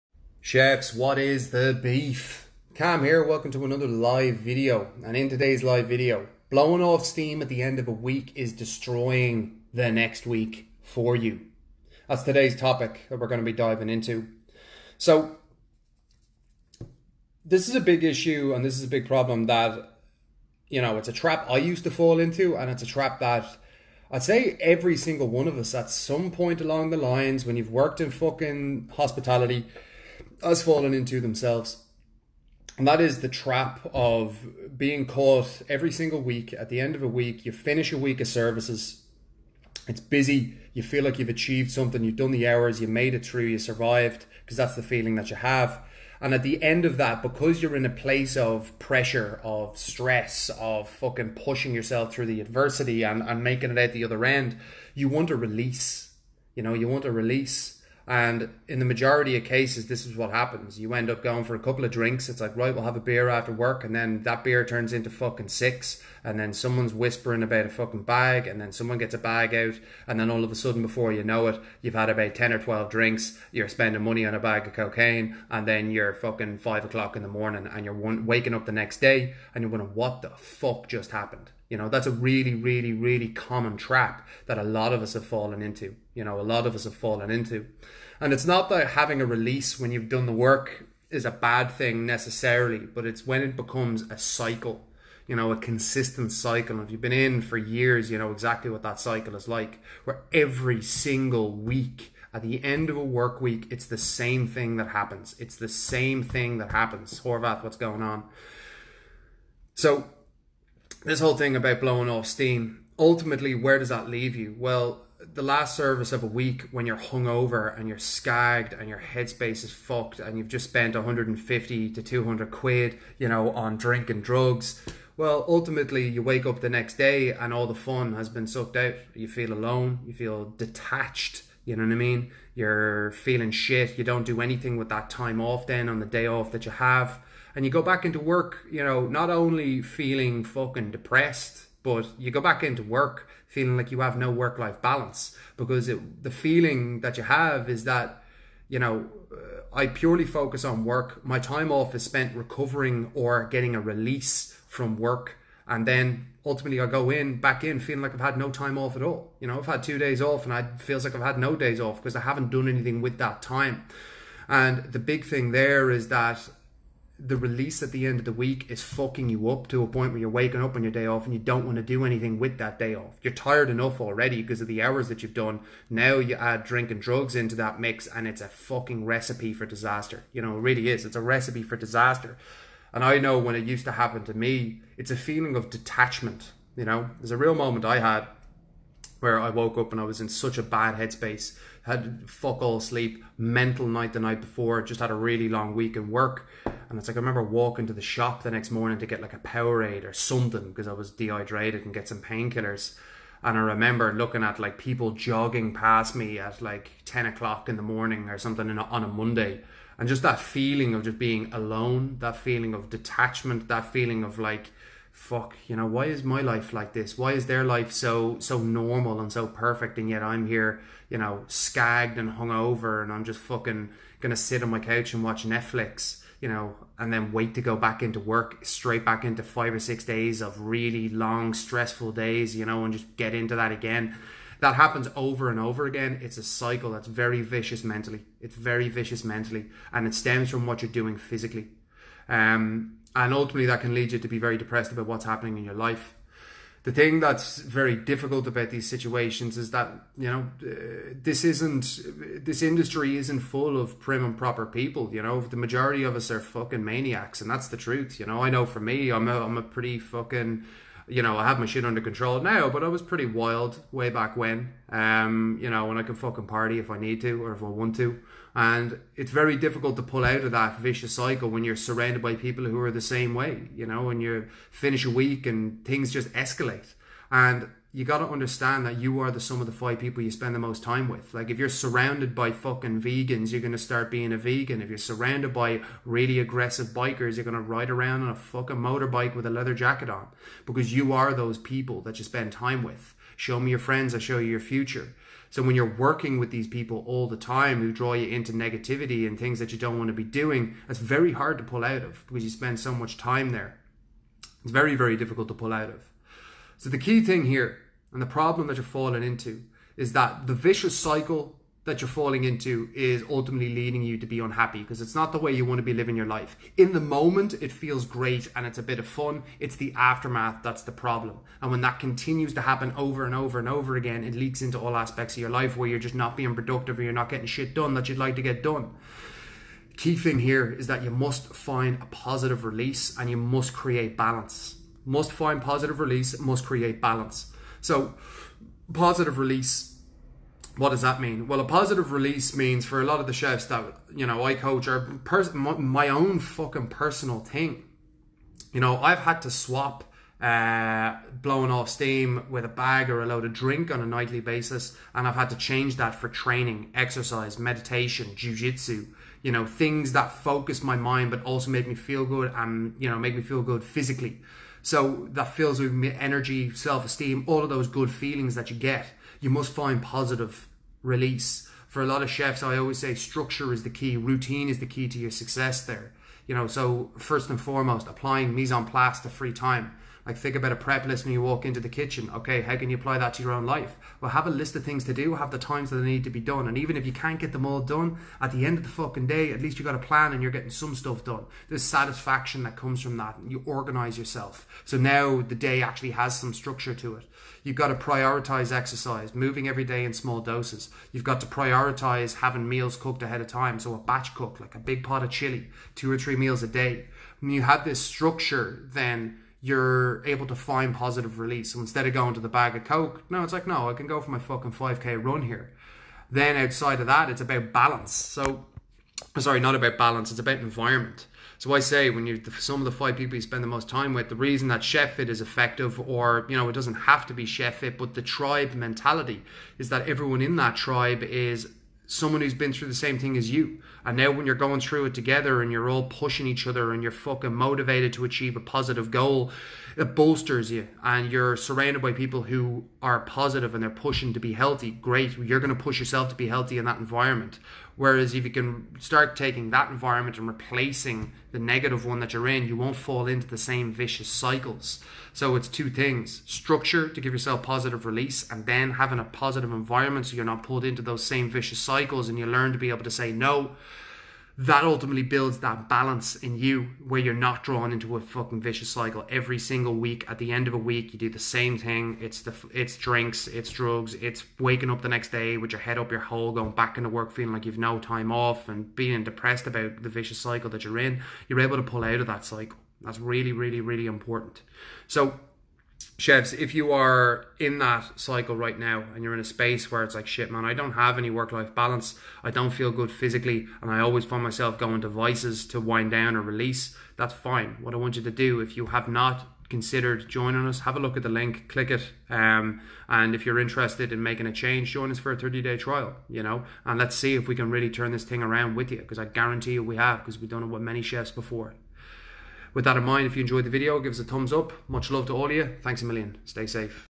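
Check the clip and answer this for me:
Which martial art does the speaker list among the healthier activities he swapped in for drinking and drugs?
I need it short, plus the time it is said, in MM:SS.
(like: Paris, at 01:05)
jujitsu, at 05:58.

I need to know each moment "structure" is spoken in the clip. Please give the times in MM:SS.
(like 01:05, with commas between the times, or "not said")
06:13, 06:36, 06:47, 07:36.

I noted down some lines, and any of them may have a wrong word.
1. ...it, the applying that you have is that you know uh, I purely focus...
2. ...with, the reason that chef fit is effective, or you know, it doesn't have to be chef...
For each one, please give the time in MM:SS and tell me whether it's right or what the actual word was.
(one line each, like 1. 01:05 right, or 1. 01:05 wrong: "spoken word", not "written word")
1. 02:25 wrong: "feeling", not "applying"
2. 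07:04 right.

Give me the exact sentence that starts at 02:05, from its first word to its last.
Well, ultimately, you wake up the next day and all the fun has been sucked out.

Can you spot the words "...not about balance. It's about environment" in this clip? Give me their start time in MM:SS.
06:59.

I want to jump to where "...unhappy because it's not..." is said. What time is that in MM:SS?
05:14.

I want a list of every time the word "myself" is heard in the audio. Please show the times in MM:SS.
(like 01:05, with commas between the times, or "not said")
08:14.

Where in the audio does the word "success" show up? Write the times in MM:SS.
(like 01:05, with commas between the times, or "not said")
06:15.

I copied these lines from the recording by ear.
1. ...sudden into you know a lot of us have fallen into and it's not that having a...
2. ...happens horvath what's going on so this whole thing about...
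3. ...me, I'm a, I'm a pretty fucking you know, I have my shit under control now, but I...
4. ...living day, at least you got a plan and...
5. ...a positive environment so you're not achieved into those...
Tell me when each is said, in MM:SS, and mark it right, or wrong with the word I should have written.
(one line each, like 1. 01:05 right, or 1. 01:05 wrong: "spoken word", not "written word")
1. 01:25 wrong: "fallen", not "sudden"
2. 01:46 right
3. 04:18 right
4. 06:28 wrong: "fucking", not "living"
5. 07:39 wrong: "pulled", not "achieved".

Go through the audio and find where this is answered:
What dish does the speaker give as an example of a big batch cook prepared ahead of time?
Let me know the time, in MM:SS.
06:45.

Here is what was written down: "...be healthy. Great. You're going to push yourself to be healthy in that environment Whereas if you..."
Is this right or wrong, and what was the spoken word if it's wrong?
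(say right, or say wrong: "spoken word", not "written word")
right.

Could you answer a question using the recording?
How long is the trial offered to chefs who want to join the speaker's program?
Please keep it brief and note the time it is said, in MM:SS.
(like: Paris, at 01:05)
30 days, at 08:25.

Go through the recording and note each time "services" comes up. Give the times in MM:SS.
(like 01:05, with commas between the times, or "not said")
00:38, 01:55.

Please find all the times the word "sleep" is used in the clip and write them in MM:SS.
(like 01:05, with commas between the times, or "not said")
03:12.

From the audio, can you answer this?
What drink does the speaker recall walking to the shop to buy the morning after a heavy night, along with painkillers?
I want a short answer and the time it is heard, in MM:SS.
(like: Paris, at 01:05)
Powerade, at 03:19.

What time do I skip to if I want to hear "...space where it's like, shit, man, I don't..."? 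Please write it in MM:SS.
08:09.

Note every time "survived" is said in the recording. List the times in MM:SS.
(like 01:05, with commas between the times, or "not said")
00:43.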